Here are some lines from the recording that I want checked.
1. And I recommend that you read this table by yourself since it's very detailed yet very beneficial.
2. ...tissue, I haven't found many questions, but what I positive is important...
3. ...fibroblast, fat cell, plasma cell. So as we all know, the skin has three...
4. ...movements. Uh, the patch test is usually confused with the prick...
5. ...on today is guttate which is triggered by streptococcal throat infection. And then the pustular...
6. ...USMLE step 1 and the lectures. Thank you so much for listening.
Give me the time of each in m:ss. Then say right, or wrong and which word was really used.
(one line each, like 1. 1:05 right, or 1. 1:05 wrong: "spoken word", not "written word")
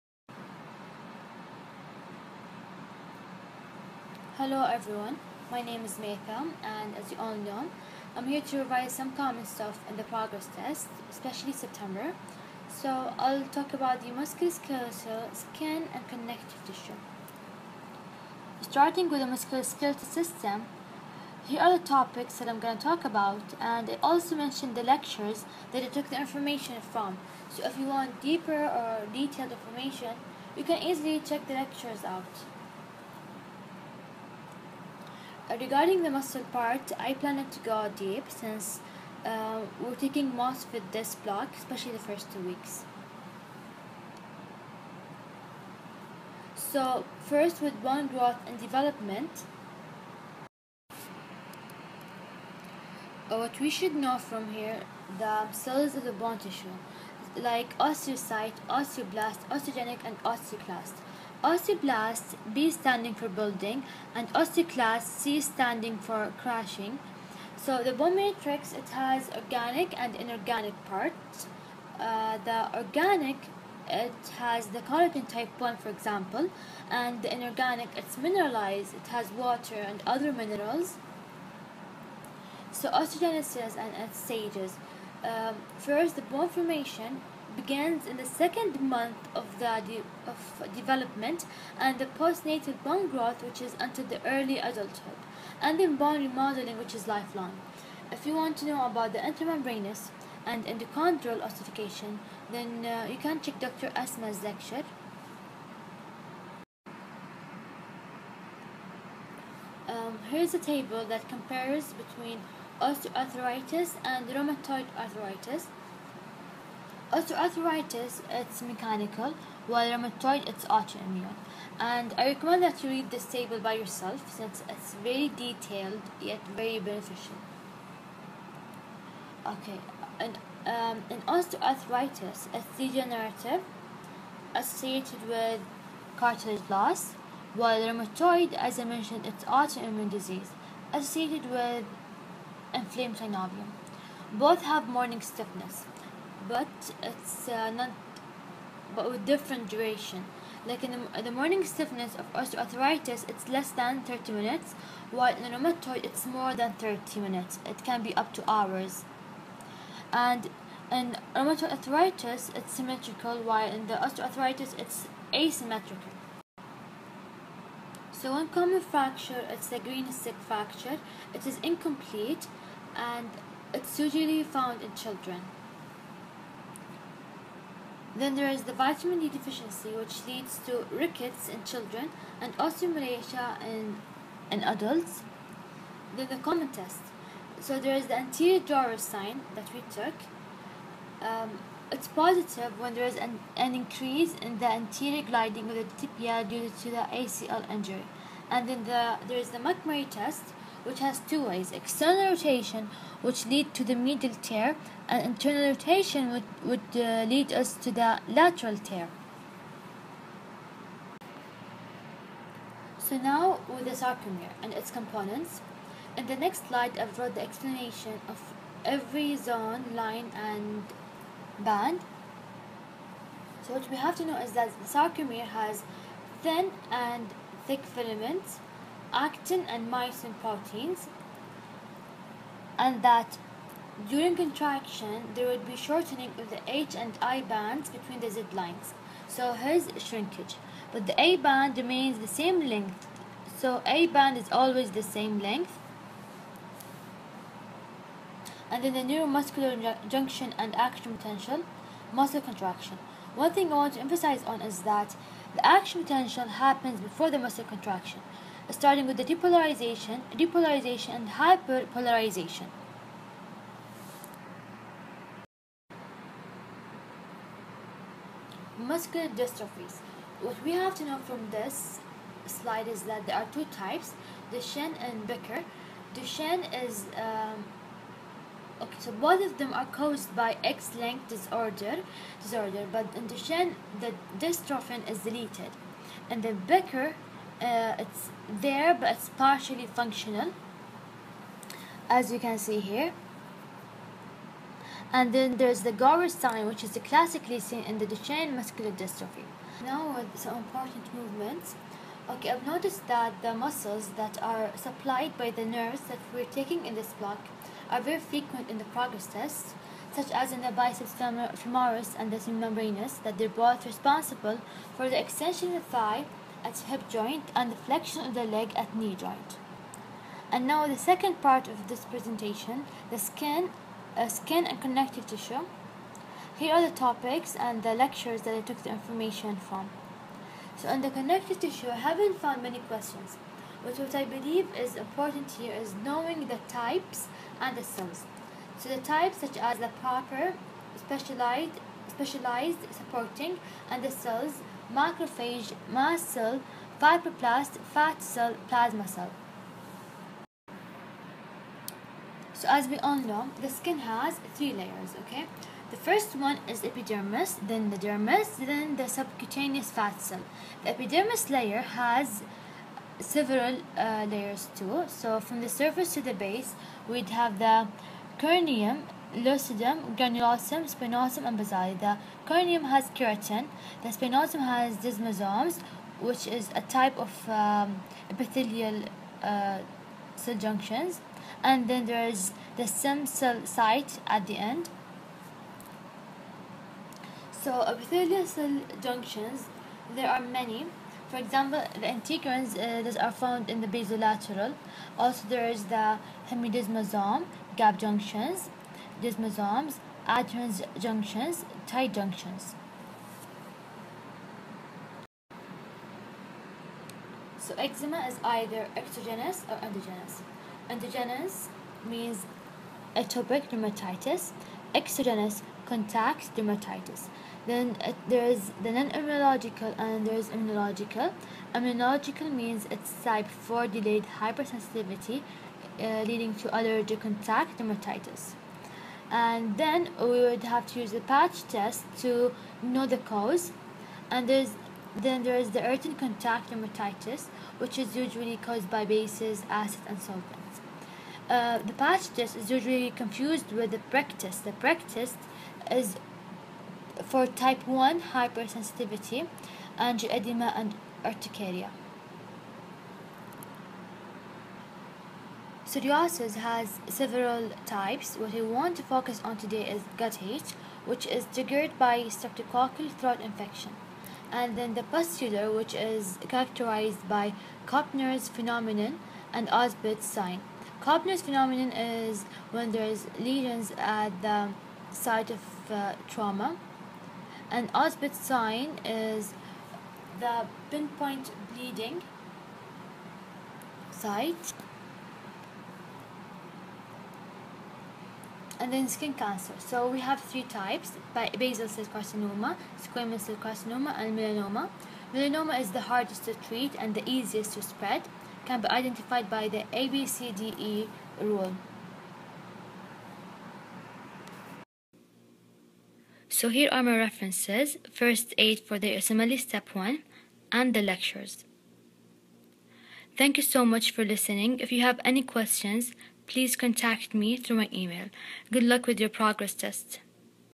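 1. 2:01 right
2. 5:31 wrong: "believe", not "positive"
3. 5:47 right
4. 7:20 wrong: "solvents", not "movements"
5. 7:39 right
6. 8:29 right.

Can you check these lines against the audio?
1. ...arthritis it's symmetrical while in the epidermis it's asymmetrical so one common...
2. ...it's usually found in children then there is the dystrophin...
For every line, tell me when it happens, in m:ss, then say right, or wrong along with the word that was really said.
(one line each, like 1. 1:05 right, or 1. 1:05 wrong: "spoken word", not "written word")
1. 2:41 wrong: "osteoarthritis", not "epidermis"
2. 2:53 wrong: "vitamin", not "dystrophin".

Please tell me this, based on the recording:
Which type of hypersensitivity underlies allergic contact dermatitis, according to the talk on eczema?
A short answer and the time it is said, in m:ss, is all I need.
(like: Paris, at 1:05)
type 4 delayed, at 7:03.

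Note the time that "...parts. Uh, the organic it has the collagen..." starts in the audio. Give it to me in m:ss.
1:10.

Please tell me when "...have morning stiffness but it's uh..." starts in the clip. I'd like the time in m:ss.
2:24.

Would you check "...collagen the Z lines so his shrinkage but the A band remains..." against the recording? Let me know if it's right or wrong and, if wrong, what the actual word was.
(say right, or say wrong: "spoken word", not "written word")
wrong: "between", not "collagen".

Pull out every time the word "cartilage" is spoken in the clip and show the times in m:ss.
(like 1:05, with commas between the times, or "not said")
2:16.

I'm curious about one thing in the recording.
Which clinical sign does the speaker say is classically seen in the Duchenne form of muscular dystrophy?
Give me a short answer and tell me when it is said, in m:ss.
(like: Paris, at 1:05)
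Gowers sign, at 4:55.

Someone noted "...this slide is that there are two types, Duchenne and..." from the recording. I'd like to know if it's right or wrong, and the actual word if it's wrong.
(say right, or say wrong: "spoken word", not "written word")
right.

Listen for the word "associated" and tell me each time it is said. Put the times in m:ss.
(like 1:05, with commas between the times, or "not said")
2:14, 2:20.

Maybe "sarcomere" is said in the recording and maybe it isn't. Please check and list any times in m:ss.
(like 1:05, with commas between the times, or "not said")
3:34, 3:44.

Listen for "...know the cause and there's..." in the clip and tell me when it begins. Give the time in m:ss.
7:12.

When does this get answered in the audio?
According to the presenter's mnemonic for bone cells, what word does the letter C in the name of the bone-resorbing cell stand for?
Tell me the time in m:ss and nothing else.
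1:06.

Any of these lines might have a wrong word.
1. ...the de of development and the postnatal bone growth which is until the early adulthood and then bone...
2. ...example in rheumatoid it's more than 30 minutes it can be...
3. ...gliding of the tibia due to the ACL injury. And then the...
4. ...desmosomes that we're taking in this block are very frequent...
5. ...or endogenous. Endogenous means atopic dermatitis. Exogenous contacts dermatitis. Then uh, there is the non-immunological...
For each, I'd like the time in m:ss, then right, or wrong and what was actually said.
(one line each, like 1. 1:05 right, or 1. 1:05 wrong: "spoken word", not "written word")
1. 1:29 right
2. 2:35 wrong: "while", not "example"
3. 3:15 right
4. 5:05 wrong: "nerves", not "desmosomes"
5. 6:49 right.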